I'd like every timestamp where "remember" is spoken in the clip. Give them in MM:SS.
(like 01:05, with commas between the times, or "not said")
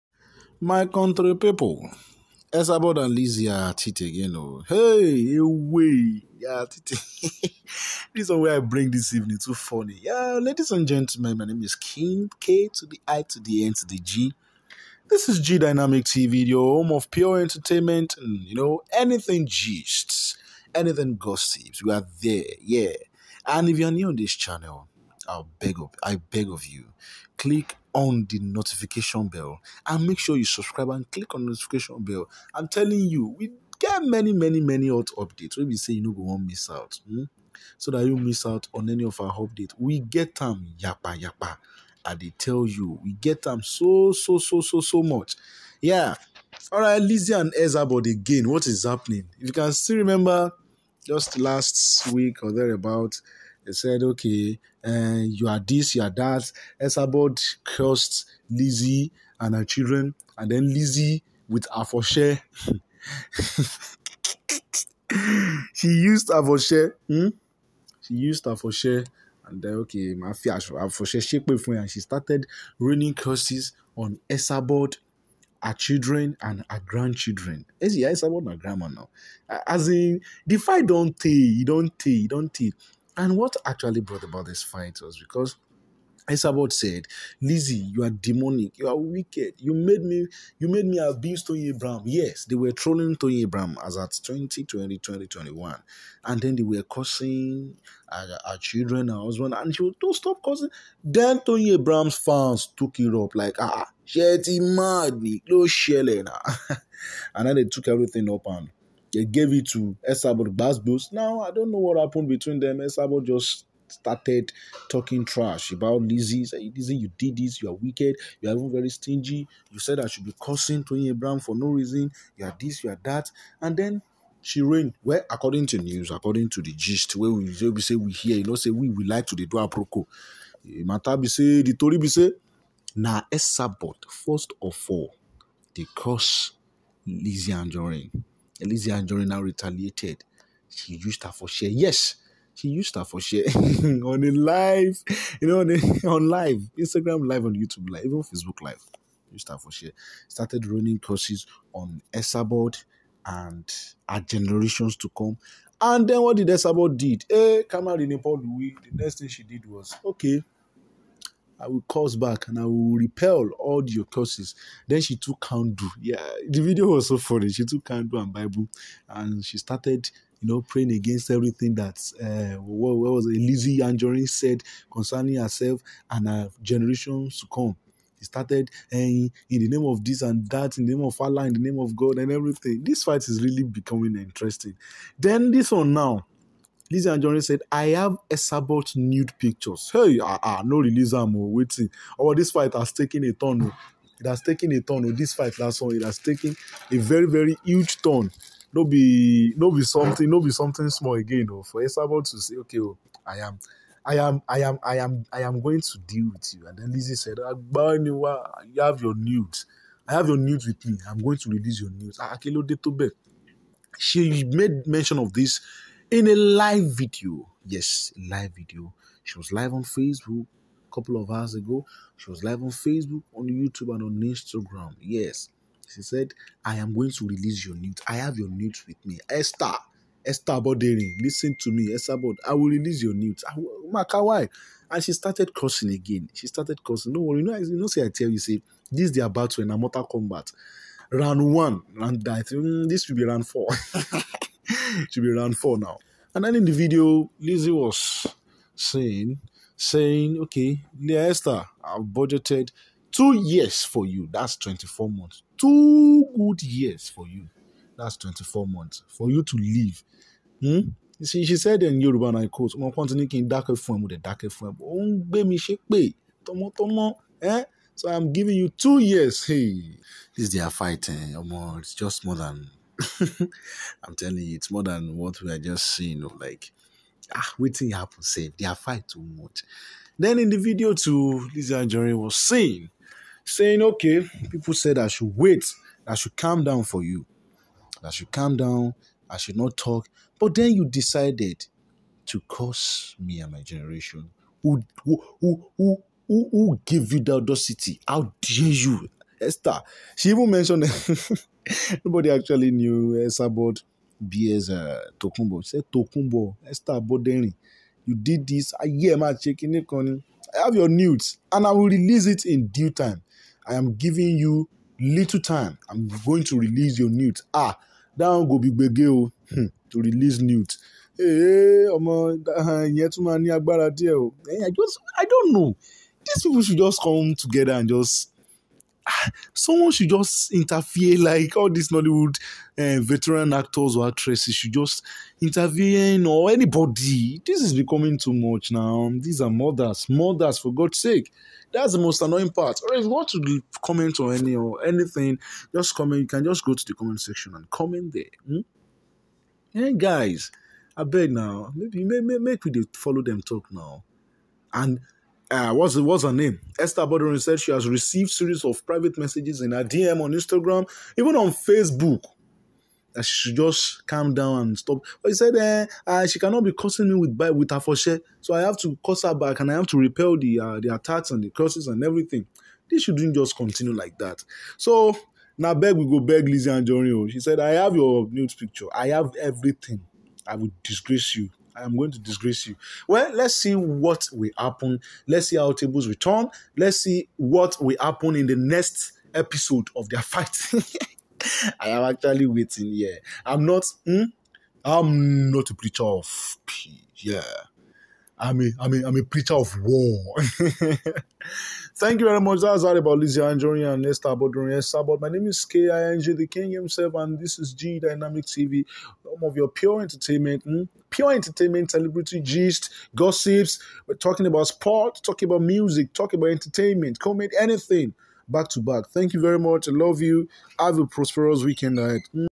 00:49.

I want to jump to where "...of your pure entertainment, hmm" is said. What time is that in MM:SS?
06:49.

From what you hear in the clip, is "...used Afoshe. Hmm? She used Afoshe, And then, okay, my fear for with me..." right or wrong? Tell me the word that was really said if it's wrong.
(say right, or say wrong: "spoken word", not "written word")
right.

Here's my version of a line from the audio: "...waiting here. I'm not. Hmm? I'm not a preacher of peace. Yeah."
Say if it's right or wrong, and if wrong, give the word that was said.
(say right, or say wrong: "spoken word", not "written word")
right.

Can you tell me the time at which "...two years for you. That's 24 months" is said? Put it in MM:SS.
04:13.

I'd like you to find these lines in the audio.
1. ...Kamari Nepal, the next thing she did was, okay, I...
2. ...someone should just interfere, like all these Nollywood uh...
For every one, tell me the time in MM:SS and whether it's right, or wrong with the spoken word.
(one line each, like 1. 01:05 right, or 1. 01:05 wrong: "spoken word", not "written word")
1. 02:37 right
2. 05:29 right.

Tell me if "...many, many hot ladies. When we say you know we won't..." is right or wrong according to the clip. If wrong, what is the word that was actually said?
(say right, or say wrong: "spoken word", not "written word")
wrong: "updates", not "ladies".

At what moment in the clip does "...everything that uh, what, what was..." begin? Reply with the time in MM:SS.
02:51.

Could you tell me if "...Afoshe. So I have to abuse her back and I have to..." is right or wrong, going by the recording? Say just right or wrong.
wrong.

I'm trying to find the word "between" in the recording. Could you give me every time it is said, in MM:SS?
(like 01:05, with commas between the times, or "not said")
01:52.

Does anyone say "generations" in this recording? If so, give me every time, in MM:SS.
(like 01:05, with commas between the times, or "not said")
02:34, 02:56, 04:53.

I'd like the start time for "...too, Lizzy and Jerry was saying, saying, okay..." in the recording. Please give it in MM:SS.
04:40.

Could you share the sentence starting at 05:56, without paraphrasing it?
Esther Bodorin said she has received series of private messages in her DM on Instagram, even on Facebook.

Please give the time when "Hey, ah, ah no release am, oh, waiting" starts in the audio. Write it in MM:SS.
03:09.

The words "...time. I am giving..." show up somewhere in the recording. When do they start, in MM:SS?
05:12.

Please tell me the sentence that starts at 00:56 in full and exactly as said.
Esabod cursed Lizzy and her children, and then Lizzy with Afoshe.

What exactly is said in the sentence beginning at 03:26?
And then Lizzie said, "Banywa, you have your nudes.